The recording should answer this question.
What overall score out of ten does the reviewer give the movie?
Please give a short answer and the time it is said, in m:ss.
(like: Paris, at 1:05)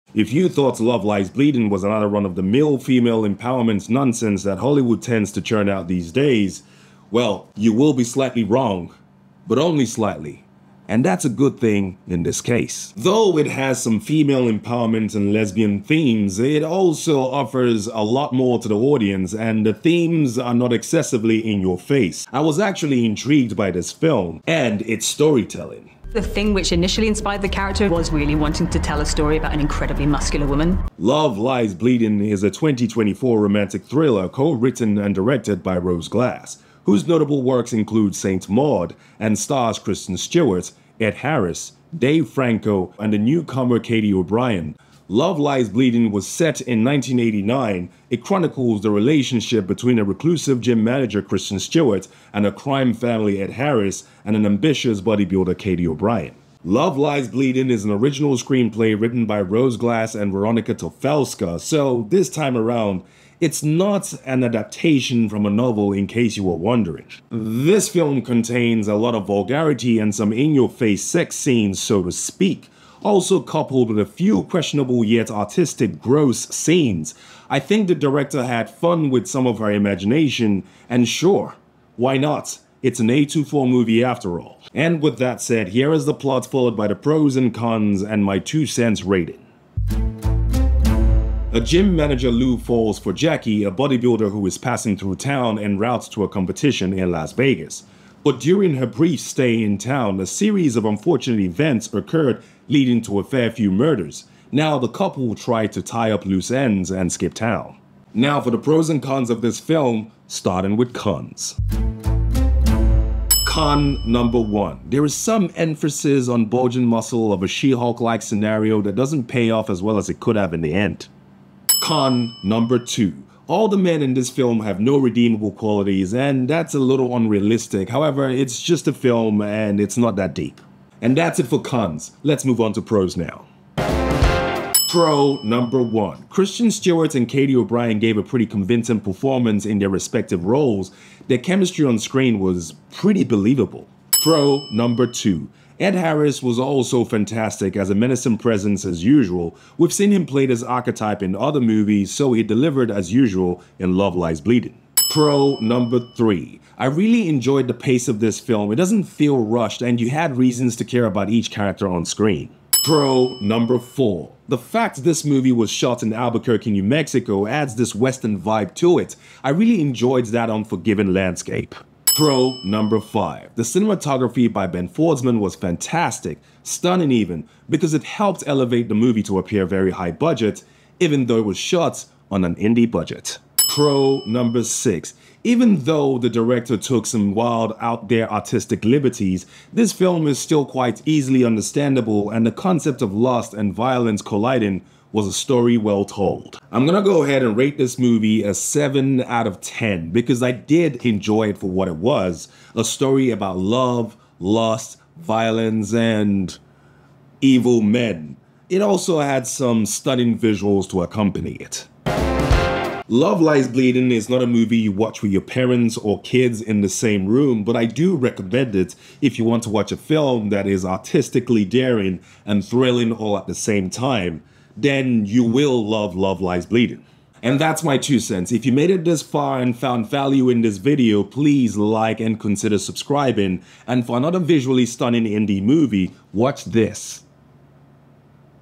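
7, at 3:18.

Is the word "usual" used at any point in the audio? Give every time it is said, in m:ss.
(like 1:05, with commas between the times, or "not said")
2:29, 2:33.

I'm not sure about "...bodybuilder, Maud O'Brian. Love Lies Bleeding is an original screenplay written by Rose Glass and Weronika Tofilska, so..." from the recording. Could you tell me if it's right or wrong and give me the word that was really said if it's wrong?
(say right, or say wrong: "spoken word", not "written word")
wrong: "Katy", not "Maud".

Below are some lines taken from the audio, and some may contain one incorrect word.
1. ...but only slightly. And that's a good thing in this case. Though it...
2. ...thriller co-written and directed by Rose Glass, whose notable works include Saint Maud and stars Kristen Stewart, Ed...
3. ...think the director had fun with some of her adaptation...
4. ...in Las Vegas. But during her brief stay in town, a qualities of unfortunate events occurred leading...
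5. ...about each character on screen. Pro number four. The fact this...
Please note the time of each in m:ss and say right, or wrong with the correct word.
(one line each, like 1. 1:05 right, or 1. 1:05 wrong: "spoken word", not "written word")
1. 0:09 right
2. 0:33 right
3. 1:17 wrong: "imagination", not "adaptation"
4. 1:36 wrong: "series", not "qualities"
5. 2:41 right.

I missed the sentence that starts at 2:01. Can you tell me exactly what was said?
Con number two all the men in this film have no redeemable qualities, and that's a little unrealistic.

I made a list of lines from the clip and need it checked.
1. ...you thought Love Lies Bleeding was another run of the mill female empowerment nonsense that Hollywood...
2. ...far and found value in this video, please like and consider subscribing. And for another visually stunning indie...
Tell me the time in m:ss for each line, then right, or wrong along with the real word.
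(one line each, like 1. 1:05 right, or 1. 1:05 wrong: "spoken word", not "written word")
1. 0:00 right
2. 3:49 right.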